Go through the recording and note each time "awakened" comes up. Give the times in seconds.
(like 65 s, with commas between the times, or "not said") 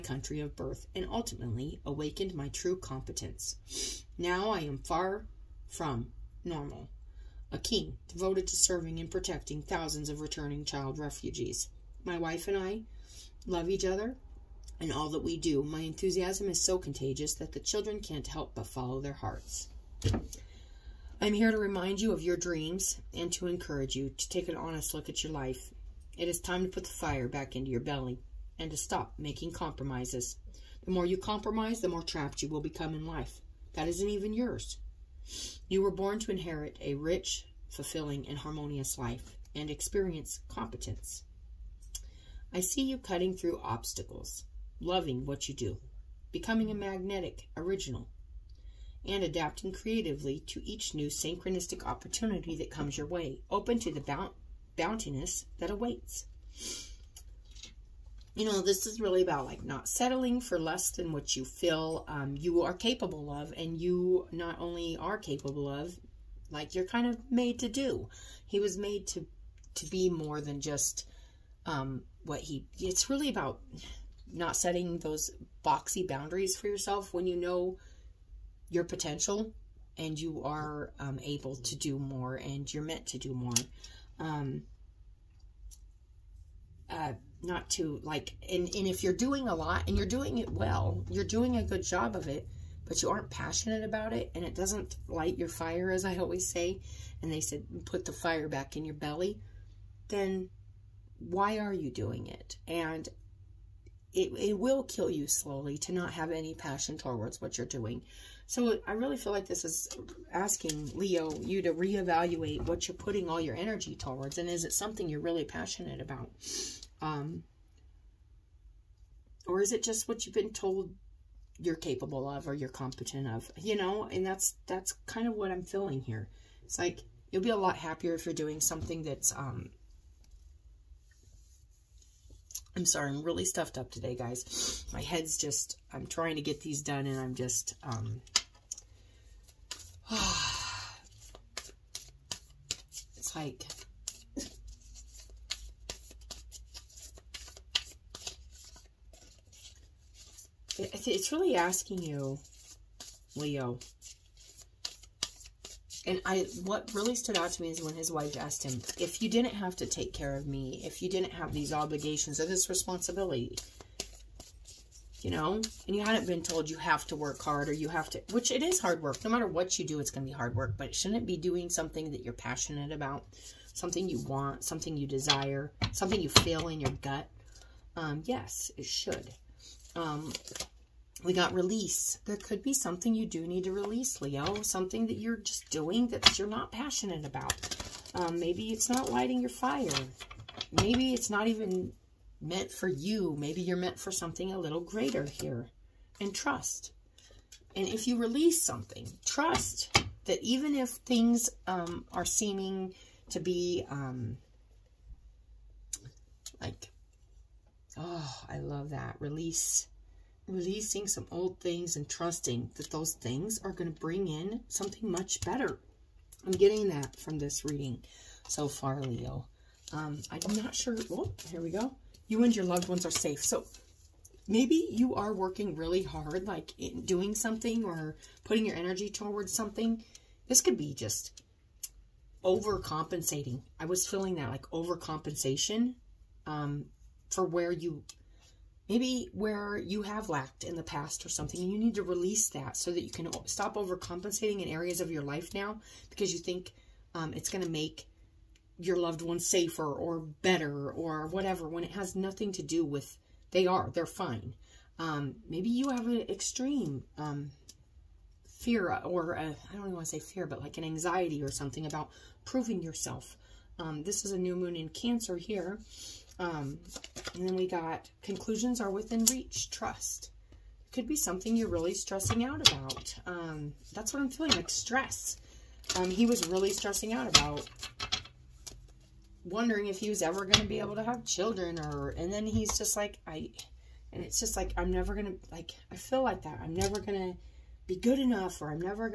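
1 s.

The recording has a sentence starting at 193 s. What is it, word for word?
Maybe you're meant for something a little greater here.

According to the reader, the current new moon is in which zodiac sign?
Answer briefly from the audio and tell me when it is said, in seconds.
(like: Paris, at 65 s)
Cancer, at 264 s.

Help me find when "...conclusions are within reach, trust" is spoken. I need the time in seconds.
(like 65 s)
268 s.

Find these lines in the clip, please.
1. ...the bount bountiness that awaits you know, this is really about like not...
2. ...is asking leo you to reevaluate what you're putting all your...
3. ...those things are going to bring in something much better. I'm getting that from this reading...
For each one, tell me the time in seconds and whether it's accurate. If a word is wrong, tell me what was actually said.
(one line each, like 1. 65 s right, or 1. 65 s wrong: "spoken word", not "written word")
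1. 53 s right
2. 109 s right
3. 212 s right.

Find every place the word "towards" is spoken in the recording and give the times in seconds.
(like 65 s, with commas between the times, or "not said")
106 s, 113 s, 229 s.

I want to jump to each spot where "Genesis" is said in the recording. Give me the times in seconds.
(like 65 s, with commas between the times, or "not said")
not said.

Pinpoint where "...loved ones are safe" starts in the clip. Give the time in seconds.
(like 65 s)
222 s.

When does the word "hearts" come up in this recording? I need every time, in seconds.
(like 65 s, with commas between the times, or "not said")
19 s.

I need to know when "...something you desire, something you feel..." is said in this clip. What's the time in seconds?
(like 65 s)
174 s.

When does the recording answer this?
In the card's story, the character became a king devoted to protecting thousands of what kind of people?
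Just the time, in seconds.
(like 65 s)
10 s.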